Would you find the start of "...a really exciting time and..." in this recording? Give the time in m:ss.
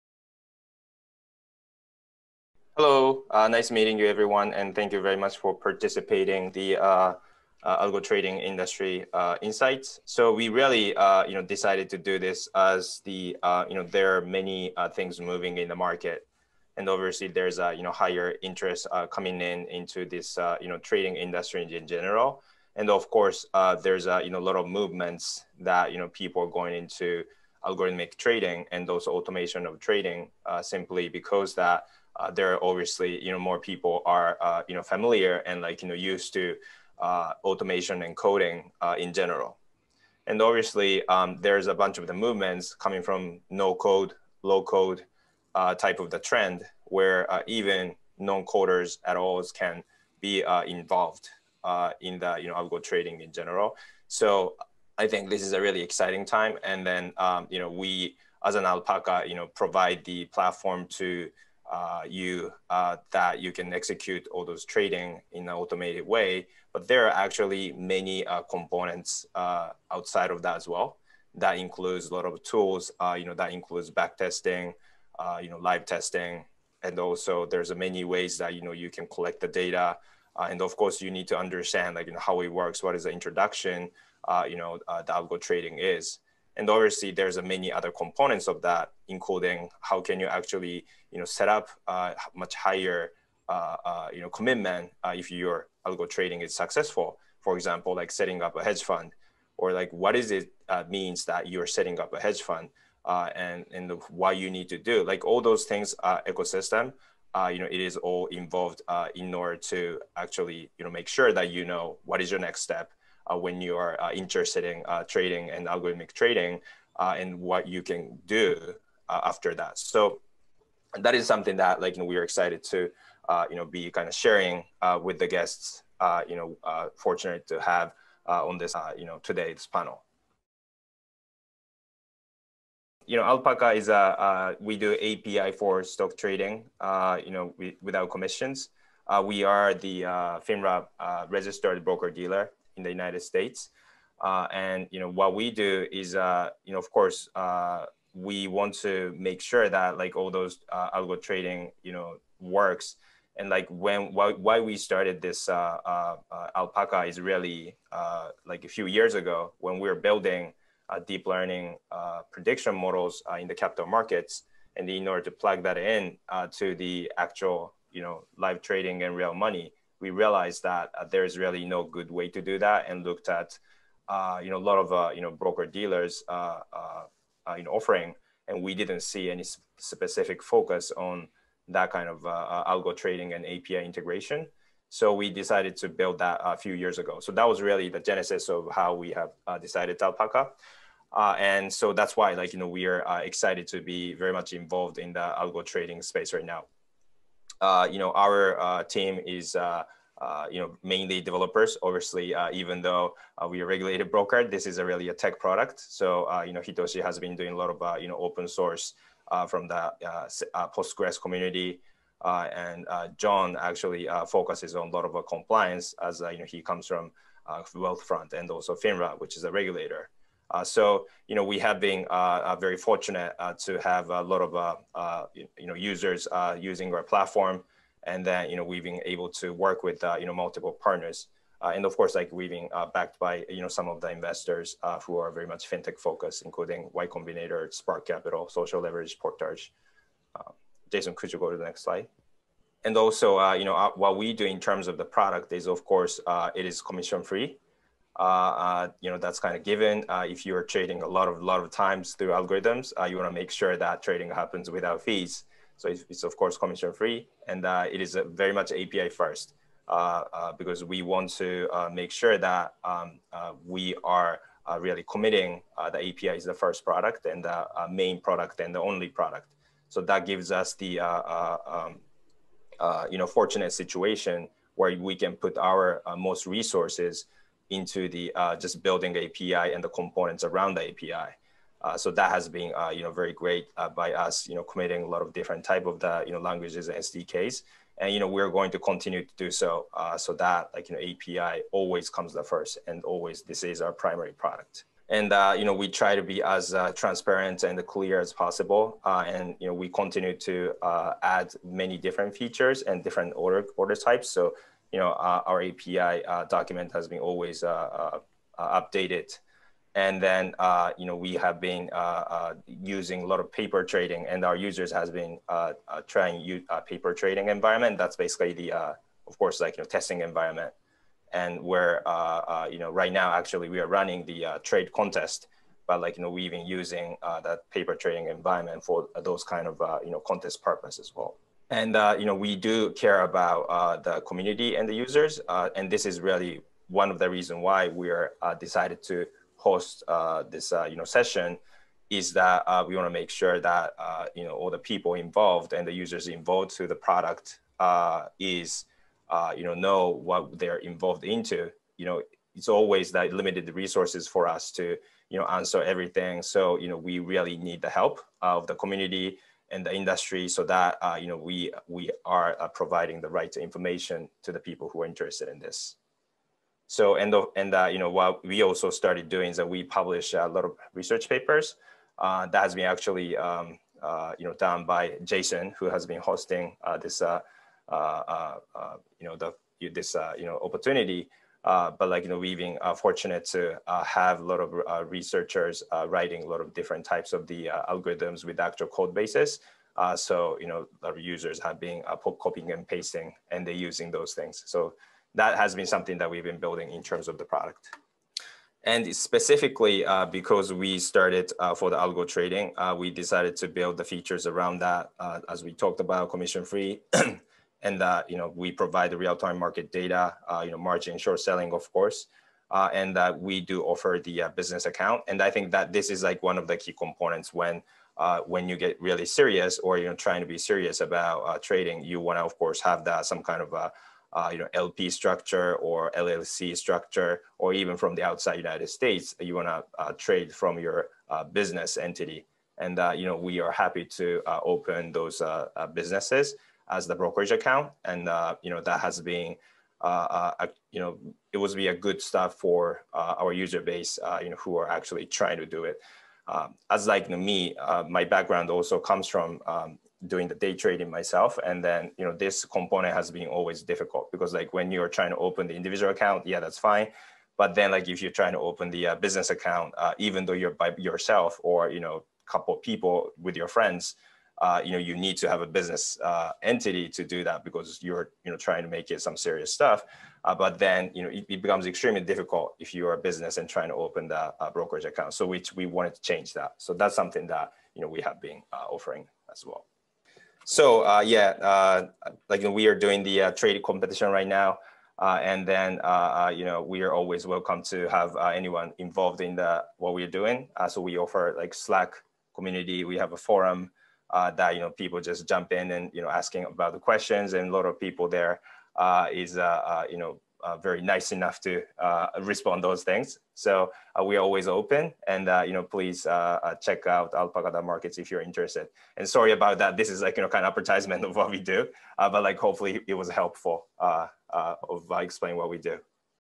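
0:55.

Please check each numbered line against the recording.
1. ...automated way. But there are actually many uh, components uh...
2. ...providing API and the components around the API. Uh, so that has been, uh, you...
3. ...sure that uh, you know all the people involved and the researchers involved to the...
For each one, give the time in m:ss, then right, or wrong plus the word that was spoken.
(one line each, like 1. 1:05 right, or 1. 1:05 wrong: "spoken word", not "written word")
1. 1:05 right
2. 4:38 wrong: "building", not "providing"
3. 5:43 wrong: "users", not "researchers".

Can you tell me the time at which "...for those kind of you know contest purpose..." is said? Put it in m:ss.
5:28.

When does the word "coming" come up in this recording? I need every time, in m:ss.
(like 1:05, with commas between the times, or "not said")
0:19, 0:42.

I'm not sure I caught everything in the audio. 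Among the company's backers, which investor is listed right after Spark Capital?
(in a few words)
Social Leverage.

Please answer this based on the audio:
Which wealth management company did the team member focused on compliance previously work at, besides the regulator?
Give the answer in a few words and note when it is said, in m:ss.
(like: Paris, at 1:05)
Wealthfront, at 3:37.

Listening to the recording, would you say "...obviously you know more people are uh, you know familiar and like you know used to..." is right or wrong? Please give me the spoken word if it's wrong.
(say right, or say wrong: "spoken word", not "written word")
right.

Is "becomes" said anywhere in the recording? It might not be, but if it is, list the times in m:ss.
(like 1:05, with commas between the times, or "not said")
7:51.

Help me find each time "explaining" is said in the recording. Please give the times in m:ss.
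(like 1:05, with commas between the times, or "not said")
8:35.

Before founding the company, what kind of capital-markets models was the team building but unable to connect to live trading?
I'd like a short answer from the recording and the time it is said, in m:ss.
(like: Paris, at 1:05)
deep learning prediction models, at 2:40.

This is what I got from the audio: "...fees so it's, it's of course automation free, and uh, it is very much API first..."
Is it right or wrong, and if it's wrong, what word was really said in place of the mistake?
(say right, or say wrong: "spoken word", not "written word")
wrong: "commission", not "automation".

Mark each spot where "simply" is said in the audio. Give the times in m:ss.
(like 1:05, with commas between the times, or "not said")
0:30.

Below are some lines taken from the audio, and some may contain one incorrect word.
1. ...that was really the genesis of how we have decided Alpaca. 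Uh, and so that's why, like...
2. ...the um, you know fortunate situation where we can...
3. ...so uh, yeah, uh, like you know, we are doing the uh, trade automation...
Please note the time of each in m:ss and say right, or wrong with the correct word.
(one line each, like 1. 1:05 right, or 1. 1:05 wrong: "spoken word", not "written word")
1. 3:07 right
2. 4:30 right
3. 8:00 wrong: "competition", not "automation".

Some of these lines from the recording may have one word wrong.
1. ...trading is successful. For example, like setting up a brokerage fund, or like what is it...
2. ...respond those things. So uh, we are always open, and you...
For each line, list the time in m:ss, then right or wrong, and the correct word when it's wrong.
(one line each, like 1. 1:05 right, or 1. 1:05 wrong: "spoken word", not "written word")
1. 1:36 wrong: "hedge", not "brokerage"
2. 8:22 right.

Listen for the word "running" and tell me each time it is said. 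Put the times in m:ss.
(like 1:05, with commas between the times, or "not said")
5:23.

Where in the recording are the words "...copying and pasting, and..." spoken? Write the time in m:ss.
6:32.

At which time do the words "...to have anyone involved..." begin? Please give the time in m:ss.
8:07.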